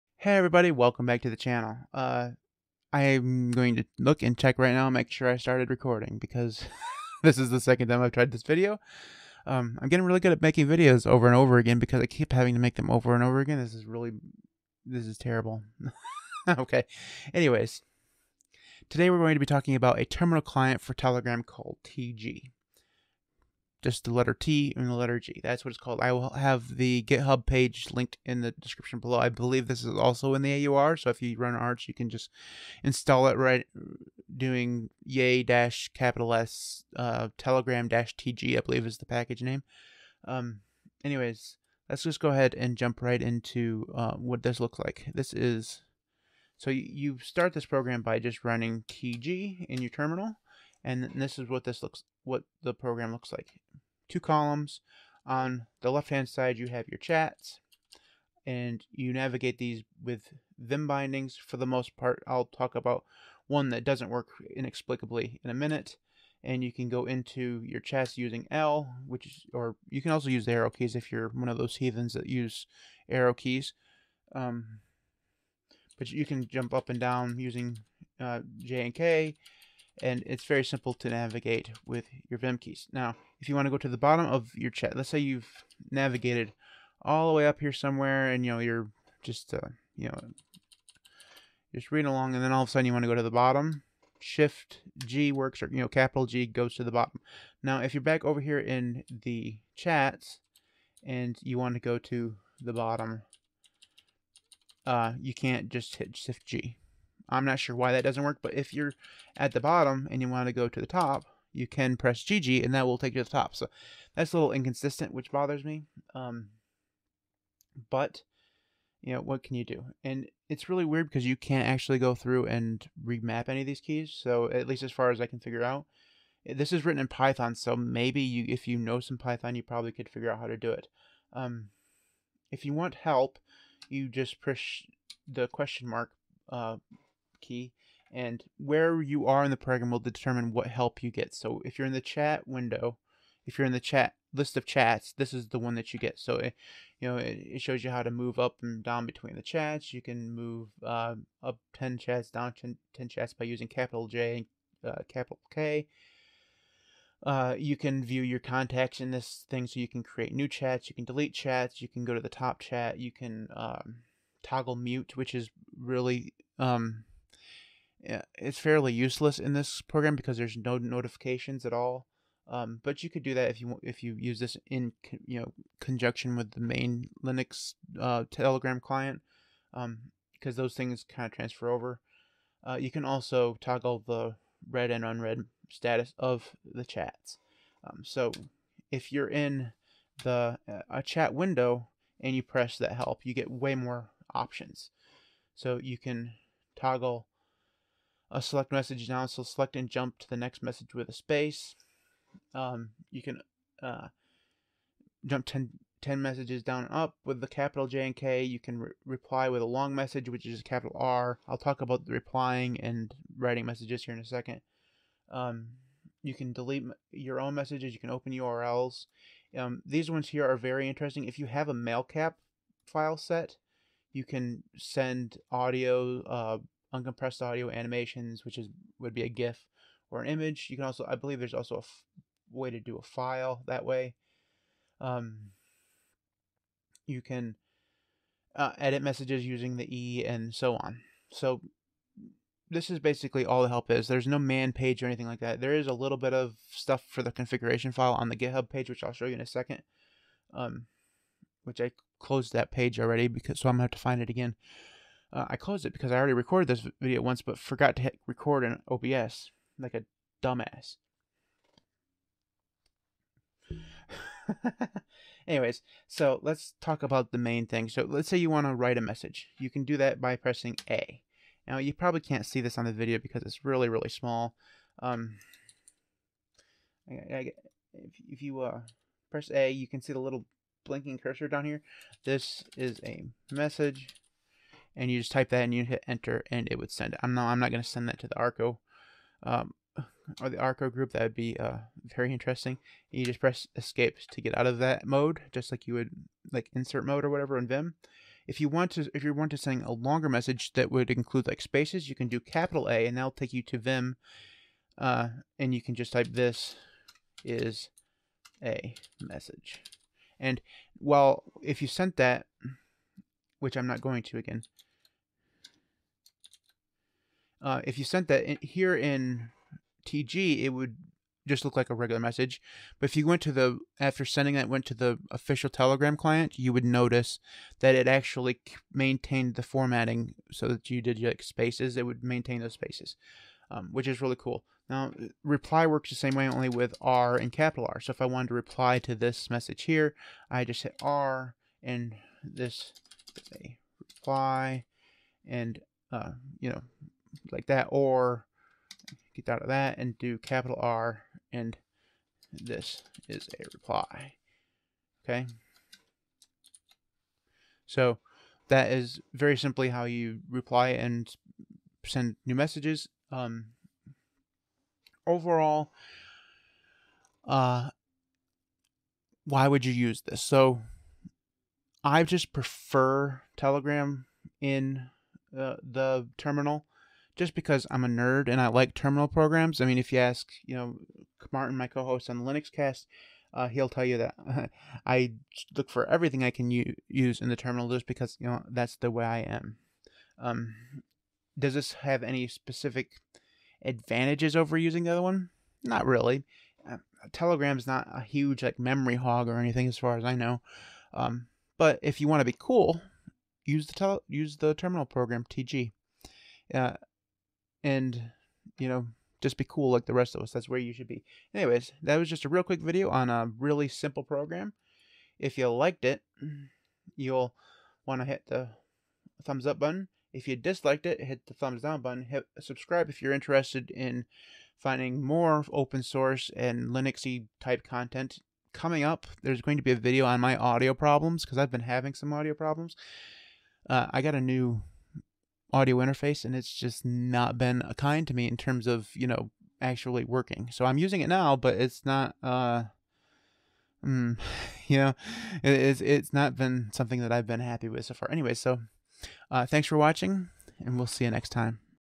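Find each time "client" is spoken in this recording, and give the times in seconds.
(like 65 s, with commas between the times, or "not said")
20 s, 178 s, 326 s.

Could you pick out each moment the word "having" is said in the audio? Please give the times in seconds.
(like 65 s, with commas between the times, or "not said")
12 s, 431 s.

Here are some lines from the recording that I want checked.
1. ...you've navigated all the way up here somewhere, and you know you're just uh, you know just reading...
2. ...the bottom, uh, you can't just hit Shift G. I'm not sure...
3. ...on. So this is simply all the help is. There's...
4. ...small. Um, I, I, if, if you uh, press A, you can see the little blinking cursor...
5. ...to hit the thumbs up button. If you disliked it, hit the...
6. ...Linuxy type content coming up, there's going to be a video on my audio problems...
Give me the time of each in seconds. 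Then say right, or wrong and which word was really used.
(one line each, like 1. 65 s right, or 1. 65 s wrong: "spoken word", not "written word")
1. 85 s right
2. 102 s right
3. 240 s wrong: "basically", not "simply"
4. 274 s right
5. 418 s right
6. 426 s right.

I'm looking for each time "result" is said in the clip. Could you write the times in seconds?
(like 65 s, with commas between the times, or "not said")
not said.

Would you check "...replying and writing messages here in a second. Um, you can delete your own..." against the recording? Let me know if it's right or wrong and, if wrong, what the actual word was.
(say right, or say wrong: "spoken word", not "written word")
right.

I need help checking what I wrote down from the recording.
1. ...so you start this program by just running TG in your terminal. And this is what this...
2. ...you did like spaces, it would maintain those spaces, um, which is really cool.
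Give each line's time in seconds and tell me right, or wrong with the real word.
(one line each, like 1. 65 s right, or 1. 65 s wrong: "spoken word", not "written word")
1. 46 s right
2. 330 s right.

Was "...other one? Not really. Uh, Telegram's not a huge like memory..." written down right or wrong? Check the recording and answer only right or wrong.
right.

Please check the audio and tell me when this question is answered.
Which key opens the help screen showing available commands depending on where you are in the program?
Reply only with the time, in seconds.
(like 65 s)
135 s.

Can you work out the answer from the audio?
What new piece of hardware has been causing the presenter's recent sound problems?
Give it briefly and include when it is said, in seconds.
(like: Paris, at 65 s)
audio interface, at 435 s.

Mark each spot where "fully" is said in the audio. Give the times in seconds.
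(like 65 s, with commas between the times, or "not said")
not said.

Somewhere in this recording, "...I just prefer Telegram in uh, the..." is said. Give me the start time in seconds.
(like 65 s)
372 s.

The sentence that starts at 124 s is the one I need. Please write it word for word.
So at least as far as I can figure out, eh, this is written in Python.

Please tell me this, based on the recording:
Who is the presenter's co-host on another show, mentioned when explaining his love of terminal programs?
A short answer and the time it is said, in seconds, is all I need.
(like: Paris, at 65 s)
Martin, at 381 s.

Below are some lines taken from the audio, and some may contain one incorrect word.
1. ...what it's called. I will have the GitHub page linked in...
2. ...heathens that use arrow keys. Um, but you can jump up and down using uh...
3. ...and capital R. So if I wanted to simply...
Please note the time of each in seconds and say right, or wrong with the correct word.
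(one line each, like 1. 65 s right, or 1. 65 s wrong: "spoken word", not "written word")
1. 25 s right
2. 71 s right
3. 337 s wrong: "reply", not "simply".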